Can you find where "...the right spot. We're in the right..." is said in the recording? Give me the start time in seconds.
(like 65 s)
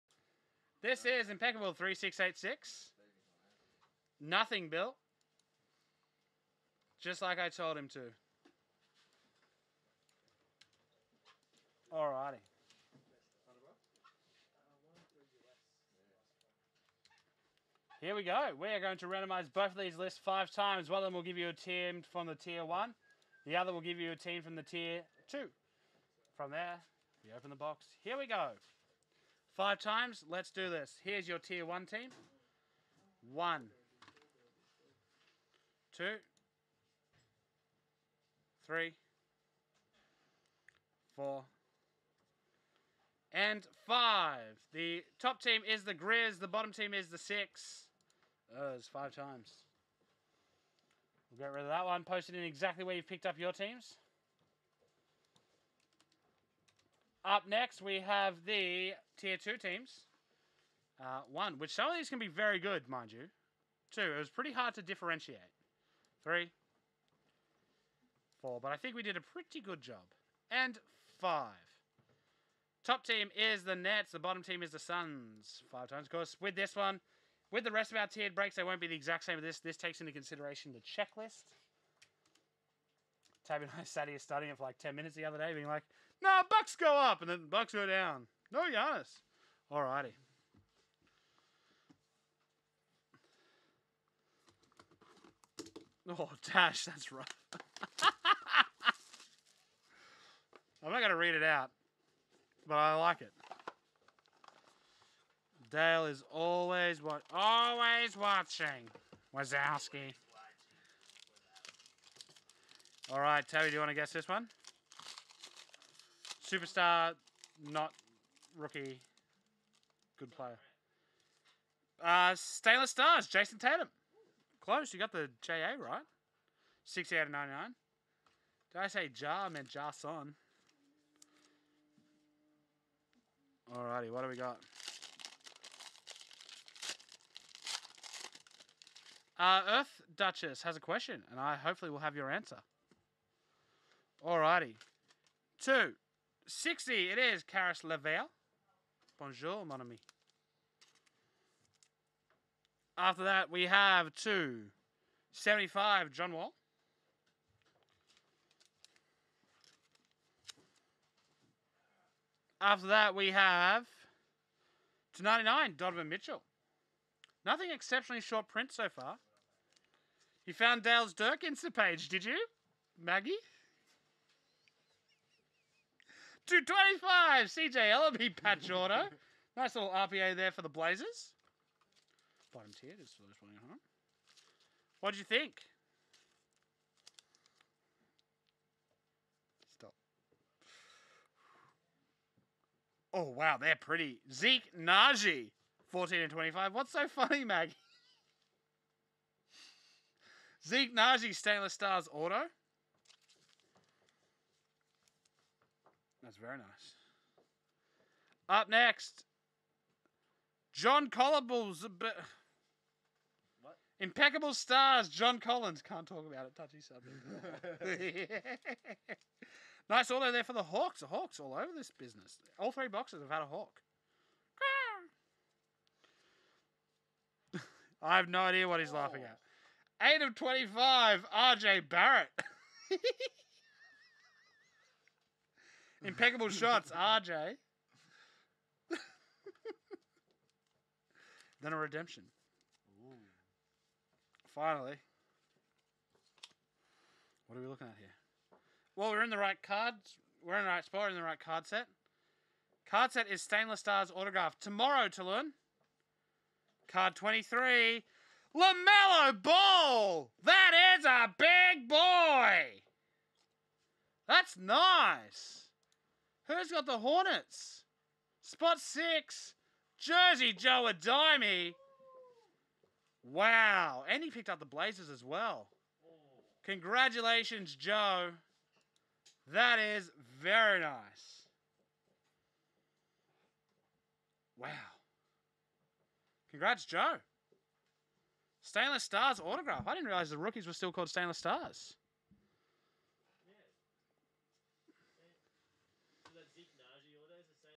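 250 s.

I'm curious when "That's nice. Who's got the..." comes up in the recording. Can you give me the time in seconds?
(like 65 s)
264 s.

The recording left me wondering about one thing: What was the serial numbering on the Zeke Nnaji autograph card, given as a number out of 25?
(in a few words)
14.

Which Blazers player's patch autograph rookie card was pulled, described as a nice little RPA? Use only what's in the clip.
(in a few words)
CJ Elleby.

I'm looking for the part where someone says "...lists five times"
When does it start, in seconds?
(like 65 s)
19 s.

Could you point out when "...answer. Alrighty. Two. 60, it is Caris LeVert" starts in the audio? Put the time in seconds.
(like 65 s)
142 s.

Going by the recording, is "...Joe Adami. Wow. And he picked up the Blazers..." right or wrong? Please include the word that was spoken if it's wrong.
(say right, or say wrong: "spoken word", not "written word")
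right.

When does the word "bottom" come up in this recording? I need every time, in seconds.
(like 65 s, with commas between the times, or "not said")
46 s, 74 s, 182 s.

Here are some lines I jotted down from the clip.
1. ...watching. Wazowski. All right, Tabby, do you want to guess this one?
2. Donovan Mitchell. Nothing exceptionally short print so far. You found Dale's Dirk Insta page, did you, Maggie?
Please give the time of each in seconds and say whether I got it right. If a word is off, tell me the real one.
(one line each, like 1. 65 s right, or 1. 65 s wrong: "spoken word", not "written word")
1. 108 s right
2. 165 s right.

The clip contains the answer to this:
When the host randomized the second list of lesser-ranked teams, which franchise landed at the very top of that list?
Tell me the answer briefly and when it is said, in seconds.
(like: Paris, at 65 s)
Nets, at 72 s.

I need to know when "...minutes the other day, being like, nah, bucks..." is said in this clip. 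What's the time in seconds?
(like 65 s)
84 s.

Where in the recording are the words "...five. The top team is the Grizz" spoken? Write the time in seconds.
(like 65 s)
43 s.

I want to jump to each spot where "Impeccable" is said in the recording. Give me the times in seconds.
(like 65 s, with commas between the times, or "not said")
1 s, 213 s, 236 s.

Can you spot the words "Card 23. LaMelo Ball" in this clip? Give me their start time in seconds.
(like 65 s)
256 s.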